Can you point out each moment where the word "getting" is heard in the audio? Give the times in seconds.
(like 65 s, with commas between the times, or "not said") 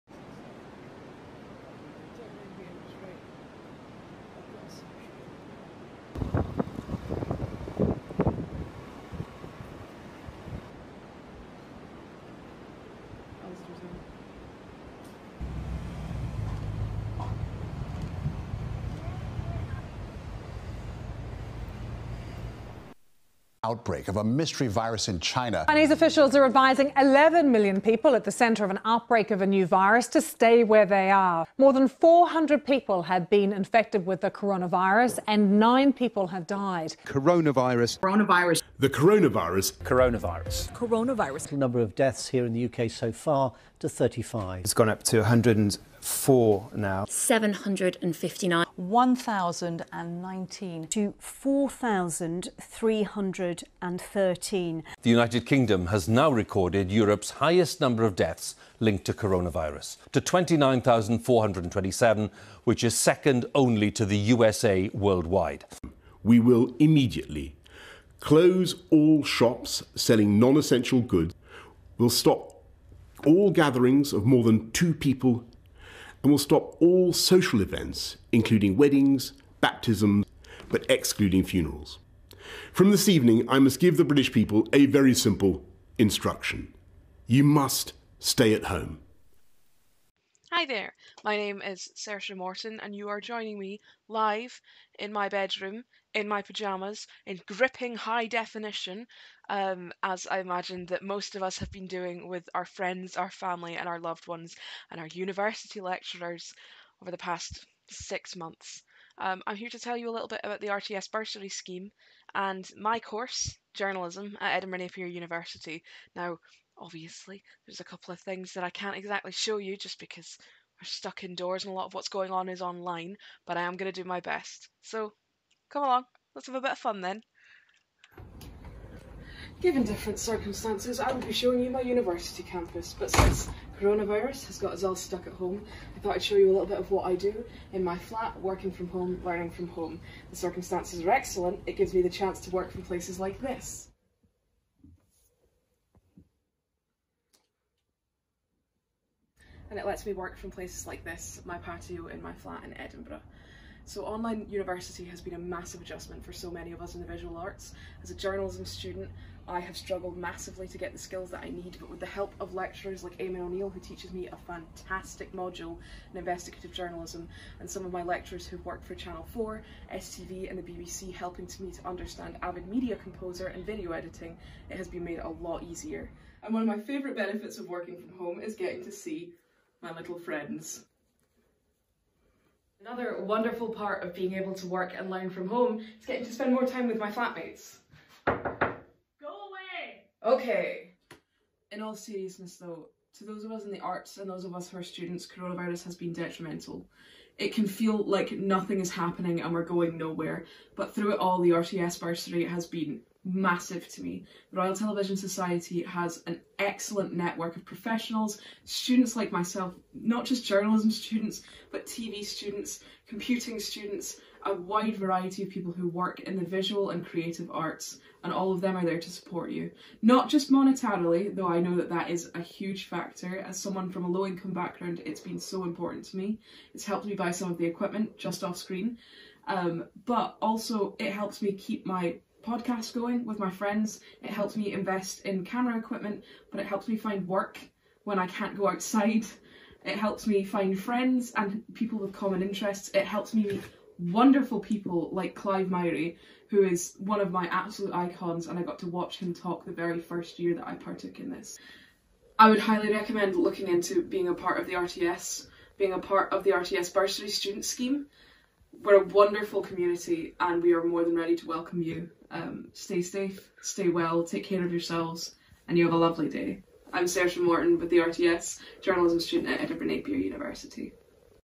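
178 s, 186 s.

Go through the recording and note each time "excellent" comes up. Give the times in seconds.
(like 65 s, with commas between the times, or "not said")
141 s, 206 s.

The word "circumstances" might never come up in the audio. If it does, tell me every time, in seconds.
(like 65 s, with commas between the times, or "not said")
130 s, 140 s.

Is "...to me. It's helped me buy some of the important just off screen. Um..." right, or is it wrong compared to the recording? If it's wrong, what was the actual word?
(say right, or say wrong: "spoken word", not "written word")
wrong: "equipment", not "important".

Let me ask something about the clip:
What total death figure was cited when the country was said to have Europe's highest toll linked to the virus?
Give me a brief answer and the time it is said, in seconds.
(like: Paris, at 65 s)
29,427, at 60 s.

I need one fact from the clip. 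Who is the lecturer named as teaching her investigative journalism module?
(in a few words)
Eamon O'Neill.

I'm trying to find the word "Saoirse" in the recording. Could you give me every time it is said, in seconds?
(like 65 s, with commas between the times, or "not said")
91 s, 267 s.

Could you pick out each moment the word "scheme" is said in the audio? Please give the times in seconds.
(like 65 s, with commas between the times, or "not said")
111 s, 257 s.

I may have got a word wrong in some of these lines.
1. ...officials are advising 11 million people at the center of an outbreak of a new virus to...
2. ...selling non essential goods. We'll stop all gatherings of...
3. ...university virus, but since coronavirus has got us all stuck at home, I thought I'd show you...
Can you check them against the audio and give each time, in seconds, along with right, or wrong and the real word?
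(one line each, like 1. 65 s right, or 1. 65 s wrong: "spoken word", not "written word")
1. 25 s right
2. 69 s right
3. 131 s wrong: "campus", not "virus".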